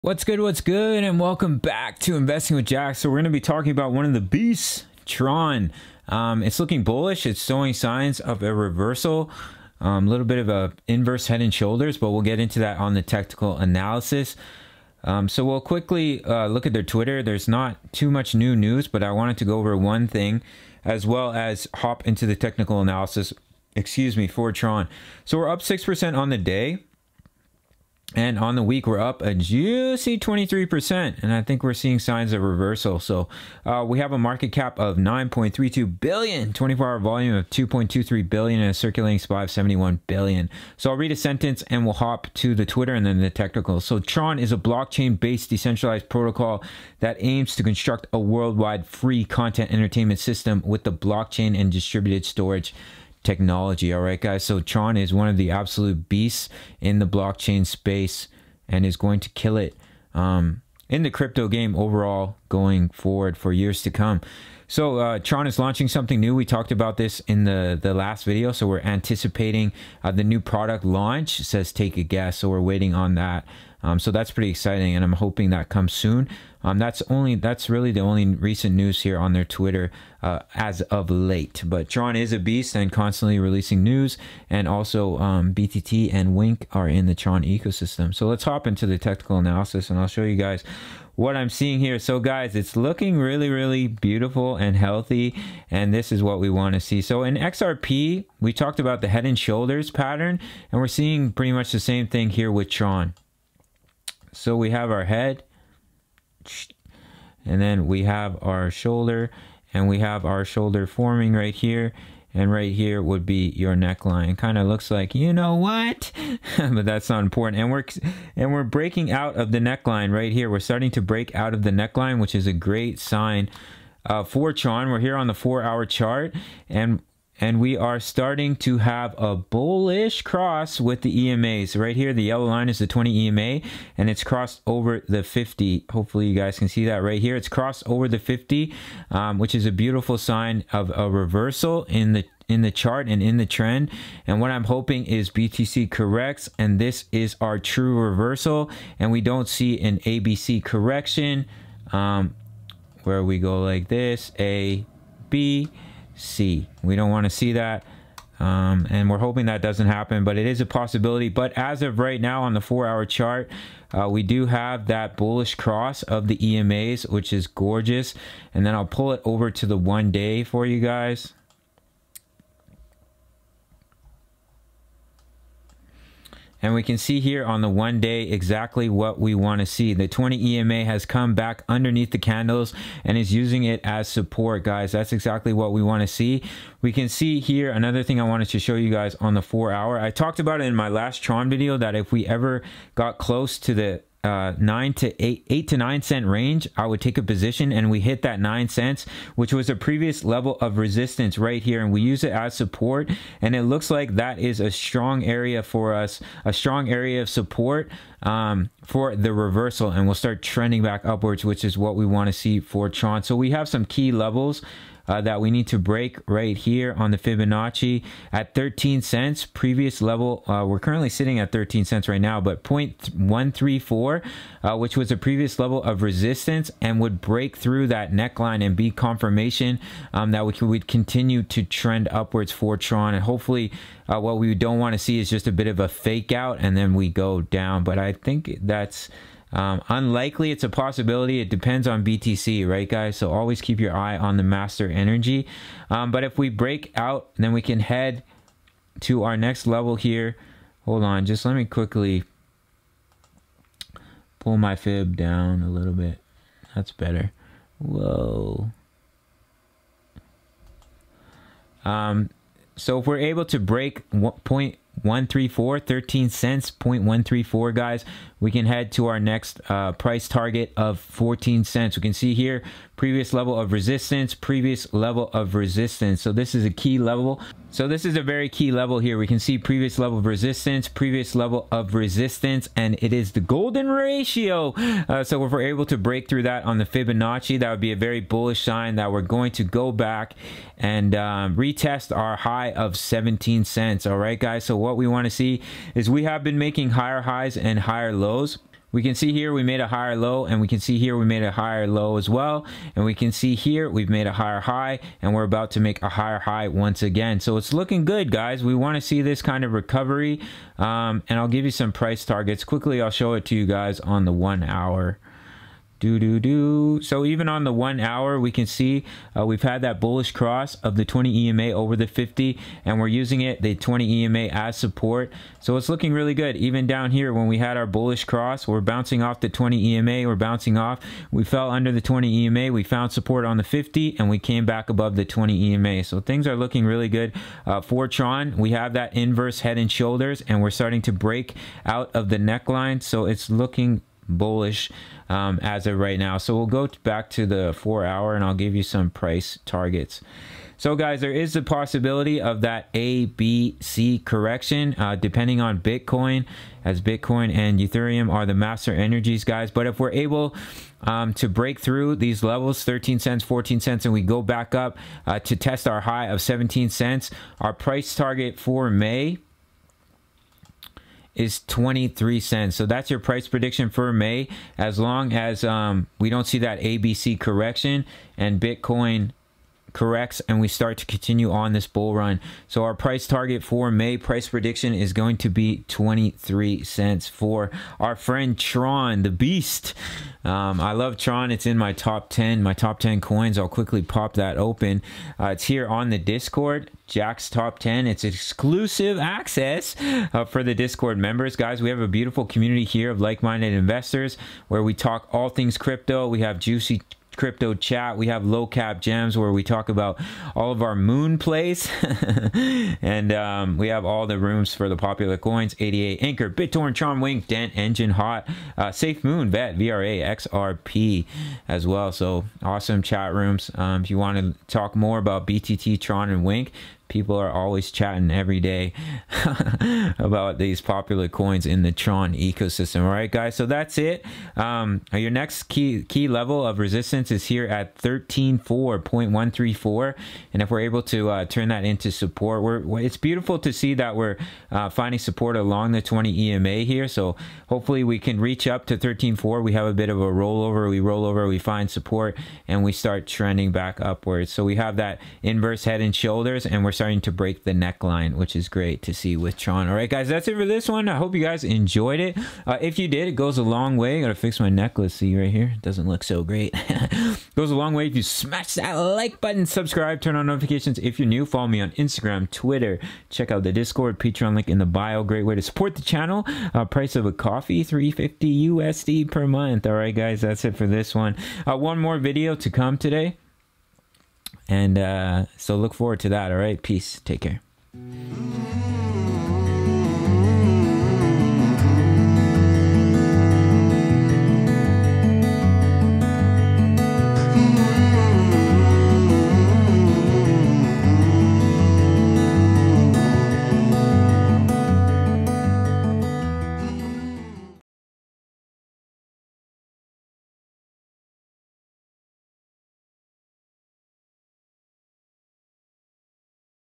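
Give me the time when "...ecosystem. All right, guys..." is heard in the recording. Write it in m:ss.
7:12.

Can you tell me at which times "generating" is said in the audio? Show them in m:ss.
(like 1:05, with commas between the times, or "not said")
not said.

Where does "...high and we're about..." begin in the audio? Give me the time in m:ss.
5:04.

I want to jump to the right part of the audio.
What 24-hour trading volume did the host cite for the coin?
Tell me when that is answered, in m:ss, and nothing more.
0:37.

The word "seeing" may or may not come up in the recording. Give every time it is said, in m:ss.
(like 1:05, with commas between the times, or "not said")
0:31, 1:31, 1:40.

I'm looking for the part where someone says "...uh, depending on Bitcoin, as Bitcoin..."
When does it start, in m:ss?
5:54.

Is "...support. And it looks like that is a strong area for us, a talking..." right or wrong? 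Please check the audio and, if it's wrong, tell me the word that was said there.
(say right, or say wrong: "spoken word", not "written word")
wrong: "strong", not "talking".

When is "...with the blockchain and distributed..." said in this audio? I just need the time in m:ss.
0:50.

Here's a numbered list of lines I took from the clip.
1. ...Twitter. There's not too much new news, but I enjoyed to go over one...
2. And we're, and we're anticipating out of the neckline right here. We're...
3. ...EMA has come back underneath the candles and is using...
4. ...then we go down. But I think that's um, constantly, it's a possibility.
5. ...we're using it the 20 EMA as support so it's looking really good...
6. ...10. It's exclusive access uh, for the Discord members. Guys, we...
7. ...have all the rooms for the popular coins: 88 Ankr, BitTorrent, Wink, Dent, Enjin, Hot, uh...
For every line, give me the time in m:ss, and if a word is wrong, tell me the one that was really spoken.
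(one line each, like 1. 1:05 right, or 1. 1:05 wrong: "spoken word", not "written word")
1. 0:16 wrong: "wanted", not "enjoyed"
2. 1:57 wrong: "breaking", not "anticipating"
3. 3:00 right
4. 3:56 wrong: "unlikely", not "constantly"
5. 5:22 right
6. 6:37 right
7. 6:53 right.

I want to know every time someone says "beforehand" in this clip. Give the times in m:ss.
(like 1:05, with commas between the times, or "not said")
not said.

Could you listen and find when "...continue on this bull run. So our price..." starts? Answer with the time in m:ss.
6:21.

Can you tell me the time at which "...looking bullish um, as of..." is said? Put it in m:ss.
5:43.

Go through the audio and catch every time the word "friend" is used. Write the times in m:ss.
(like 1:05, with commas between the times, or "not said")
6:28.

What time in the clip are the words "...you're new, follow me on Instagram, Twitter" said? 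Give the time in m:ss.
7:51.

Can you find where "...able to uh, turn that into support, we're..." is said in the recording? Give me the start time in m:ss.
7:20.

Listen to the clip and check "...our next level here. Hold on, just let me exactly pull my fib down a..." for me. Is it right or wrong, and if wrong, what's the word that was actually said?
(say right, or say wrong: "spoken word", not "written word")
wrong: "quickly", not "exactly".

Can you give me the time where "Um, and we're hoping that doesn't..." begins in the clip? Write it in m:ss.
2:38.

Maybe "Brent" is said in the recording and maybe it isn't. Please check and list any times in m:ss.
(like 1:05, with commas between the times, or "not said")
not said.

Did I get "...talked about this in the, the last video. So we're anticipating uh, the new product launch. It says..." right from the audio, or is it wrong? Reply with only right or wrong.
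right.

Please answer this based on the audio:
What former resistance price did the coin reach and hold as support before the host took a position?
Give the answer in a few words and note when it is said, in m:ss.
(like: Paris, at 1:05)
9 cents, at 3:18.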